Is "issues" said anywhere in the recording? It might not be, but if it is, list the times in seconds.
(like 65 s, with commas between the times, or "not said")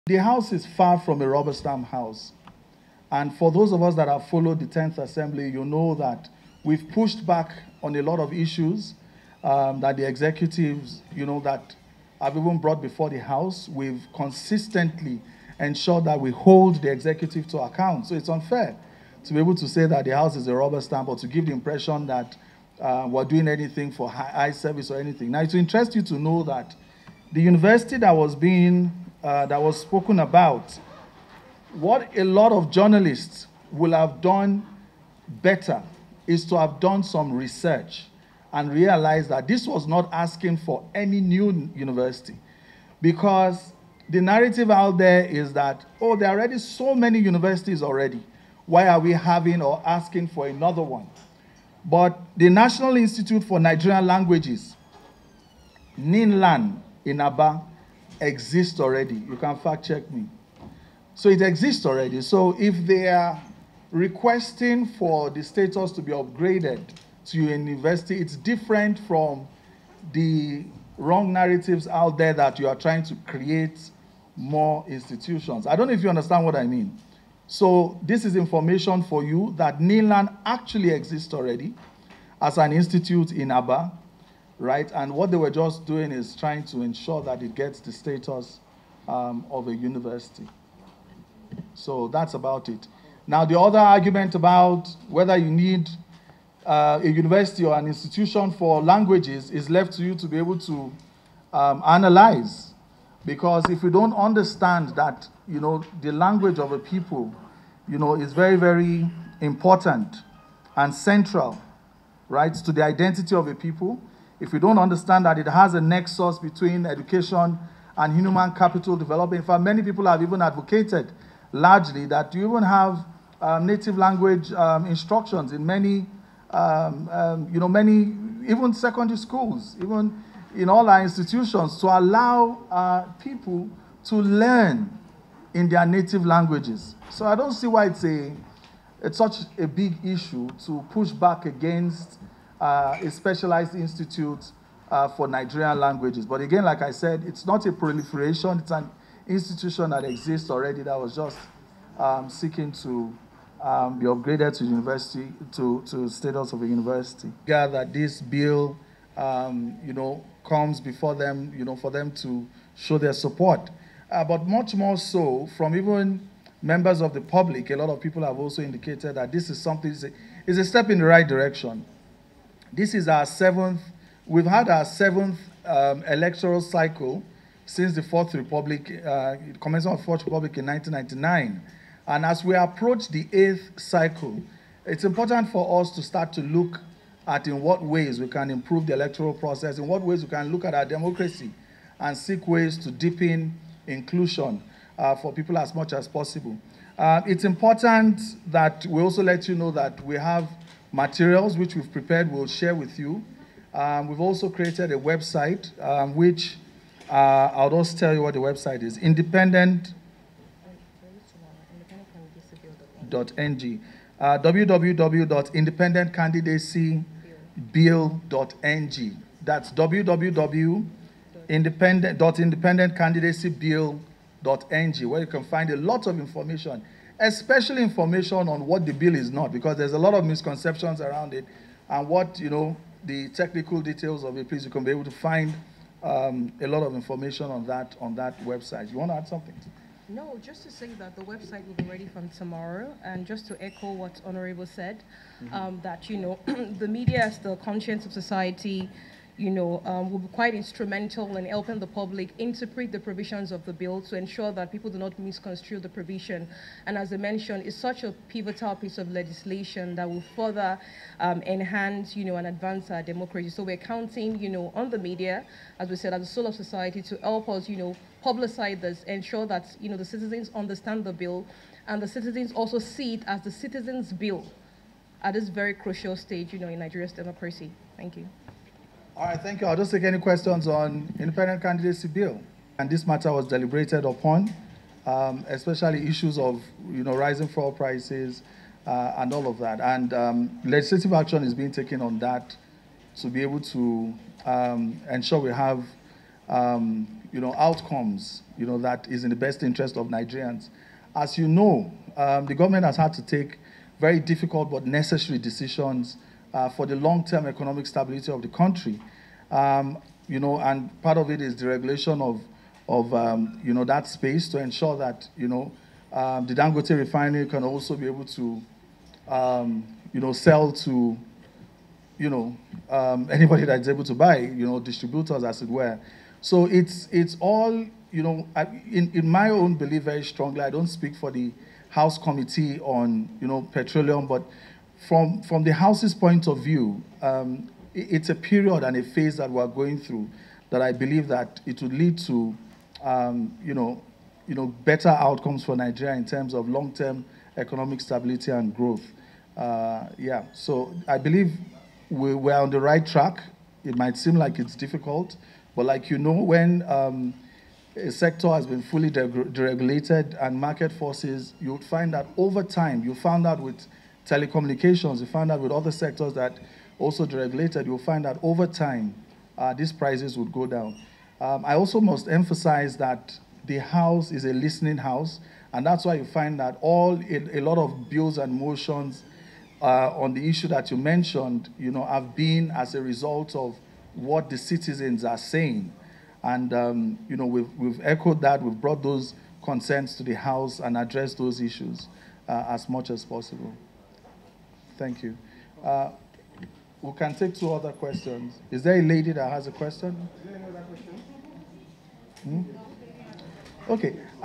8 s, 140 s, 286 s, 380 s, 391 s.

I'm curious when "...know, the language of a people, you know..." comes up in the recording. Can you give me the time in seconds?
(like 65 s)
105 s.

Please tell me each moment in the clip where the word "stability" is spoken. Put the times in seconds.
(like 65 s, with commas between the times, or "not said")
307 s, 348 s.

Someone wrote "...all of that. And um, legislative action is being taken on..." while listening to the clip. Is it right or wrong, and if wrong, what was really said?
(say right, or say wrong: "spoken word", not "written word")
right.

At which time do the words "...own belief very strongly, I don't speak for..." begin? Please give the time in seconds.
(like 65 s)
329 s.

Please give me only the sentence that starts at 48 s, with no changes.
Why are we having or asking for another one?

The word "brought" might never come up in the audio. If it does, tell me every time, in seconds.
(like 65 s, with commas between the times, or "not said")
12 s, 388 s.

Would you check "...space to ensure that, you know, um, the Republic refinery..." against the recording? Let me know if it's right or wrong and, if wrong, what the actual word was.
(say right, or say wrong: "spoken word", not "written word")
wrong: "Dangote", not "Republic".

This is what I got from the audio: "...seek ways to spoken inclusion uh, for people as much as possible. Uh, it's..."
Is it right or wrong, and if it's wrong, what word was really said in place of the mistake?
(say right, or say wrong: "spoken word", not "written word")
wrong: "deepen", not "spoken".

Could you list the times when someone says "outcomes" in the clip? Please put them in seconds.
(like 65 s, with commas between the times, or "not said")
297 s, 345 s.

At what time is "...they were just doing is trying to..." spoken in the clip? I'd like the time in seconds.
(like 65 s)
85 s.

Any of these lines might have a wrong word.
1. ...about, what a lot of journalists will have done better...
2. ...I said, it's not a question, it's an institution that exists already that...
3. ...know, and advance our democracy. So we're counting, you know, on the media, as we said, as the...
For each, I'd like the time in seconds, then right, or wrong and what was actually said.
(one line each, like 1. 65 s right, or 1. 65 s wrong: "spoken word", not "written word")
1. 30 s right
2. 146 s wrong: "proliferation", not "question"
3. 262 s right.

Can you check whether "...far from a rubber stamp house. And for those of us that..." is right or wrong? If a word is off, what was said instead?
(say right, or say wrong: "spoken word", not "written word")
right.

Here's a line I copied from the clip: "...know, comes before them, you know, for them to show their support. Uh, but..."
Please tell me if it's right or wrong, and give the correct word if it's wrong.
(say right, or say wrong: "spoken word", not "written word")
right.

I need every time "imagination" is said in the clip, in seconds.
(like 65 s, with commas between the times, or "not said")
not said.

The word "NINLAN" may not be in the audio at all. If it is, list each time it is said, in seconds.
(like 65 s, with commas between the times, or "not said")
55 s, 79 s.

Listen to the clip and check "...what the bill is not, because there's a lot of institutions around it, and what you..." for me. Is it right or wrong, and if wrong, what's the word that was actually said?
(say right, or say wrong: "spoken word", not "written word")
wrong: "misconceptions", not "institutions".